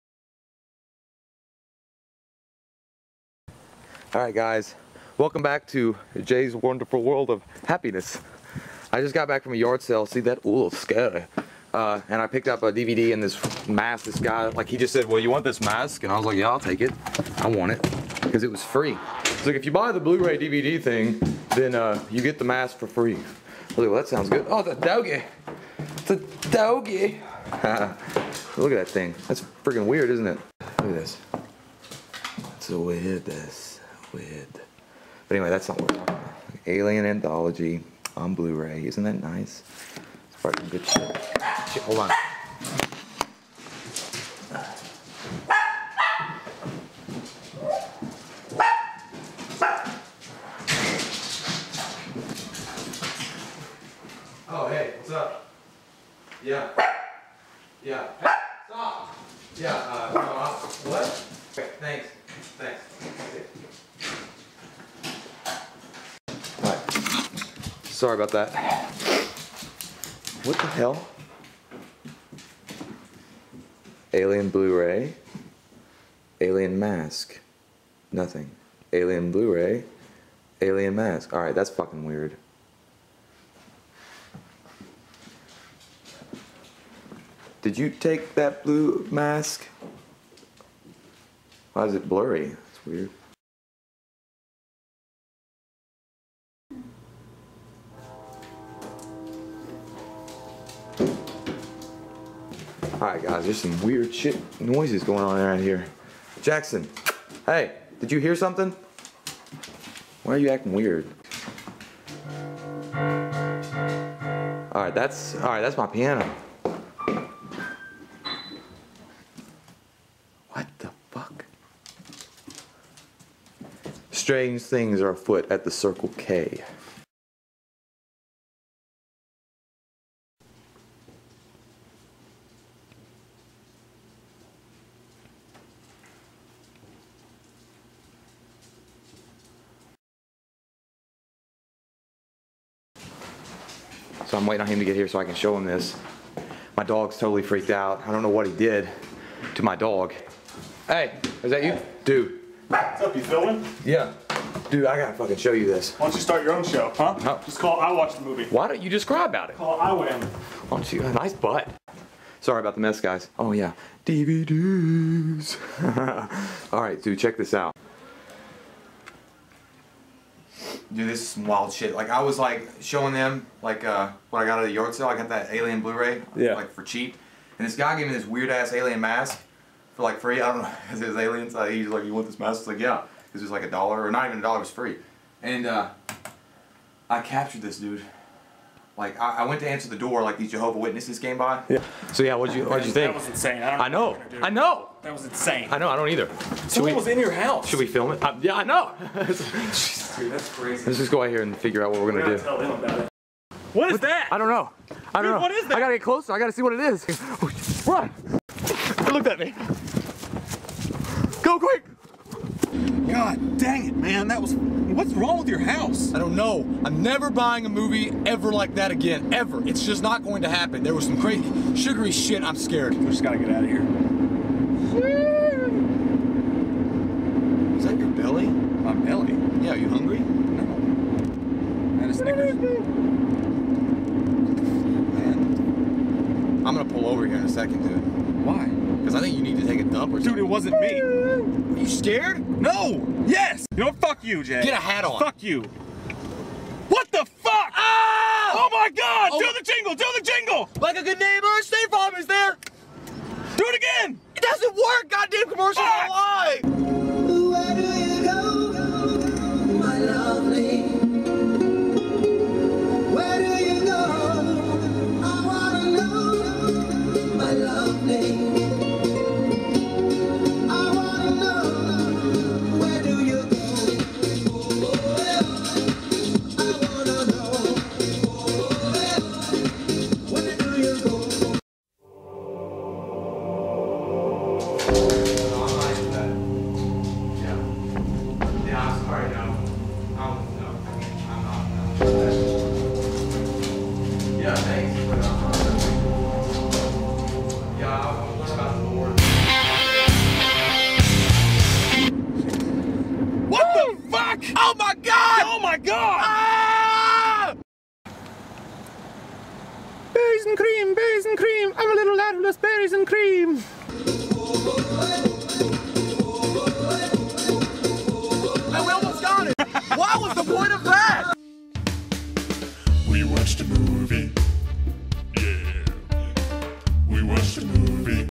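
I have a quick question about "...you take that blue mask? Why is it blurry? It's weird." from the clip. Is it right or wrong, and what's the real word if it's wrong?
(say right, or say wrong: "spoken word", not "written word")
right.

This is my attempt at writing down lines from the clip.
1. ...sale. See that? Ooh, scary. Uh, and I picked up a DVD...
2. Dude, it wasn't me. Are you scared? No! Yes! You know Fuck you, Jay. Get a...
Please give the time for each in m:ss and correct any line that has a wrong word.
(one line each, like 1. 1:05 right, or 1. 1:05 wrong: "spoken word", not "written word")
1. 0:09 right
2. 4:00 right.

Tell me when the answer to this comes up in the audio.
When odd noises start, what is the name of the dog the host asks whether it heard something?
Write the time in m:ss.
1:46.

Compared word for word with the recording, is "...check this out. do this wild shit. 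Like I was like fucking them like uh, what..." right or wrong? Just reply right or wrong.
wrong.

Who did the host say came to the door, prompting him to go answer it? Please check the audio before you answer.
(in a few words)
Jehovah Witnesses.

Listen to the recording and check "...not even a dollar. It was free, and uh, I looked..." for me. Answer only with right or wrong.
wrong.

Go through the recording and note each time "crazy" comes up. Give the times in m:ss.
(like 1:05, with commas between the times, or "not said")
3:20, 3:41.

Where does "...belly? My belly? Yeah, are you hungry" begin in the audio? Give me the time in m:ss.
3:48.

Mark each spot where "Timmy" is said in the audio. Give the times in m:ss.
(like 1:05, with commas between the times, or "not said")
not said.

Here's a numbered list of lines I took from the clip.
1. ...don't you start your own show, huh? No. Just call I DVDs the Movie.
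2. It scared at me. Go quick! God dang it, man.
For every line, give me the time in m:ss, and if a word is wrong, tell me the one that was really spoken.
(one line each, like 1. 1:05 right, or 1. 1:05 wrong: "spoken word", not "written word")
1. 2:36 wrong: "Watch", not "DVDs"
2. 3:28 wrong: "looked", not "scared".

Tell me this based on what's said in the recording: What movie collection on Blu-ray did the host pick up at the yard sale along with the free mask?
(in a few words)
Alien Anthology.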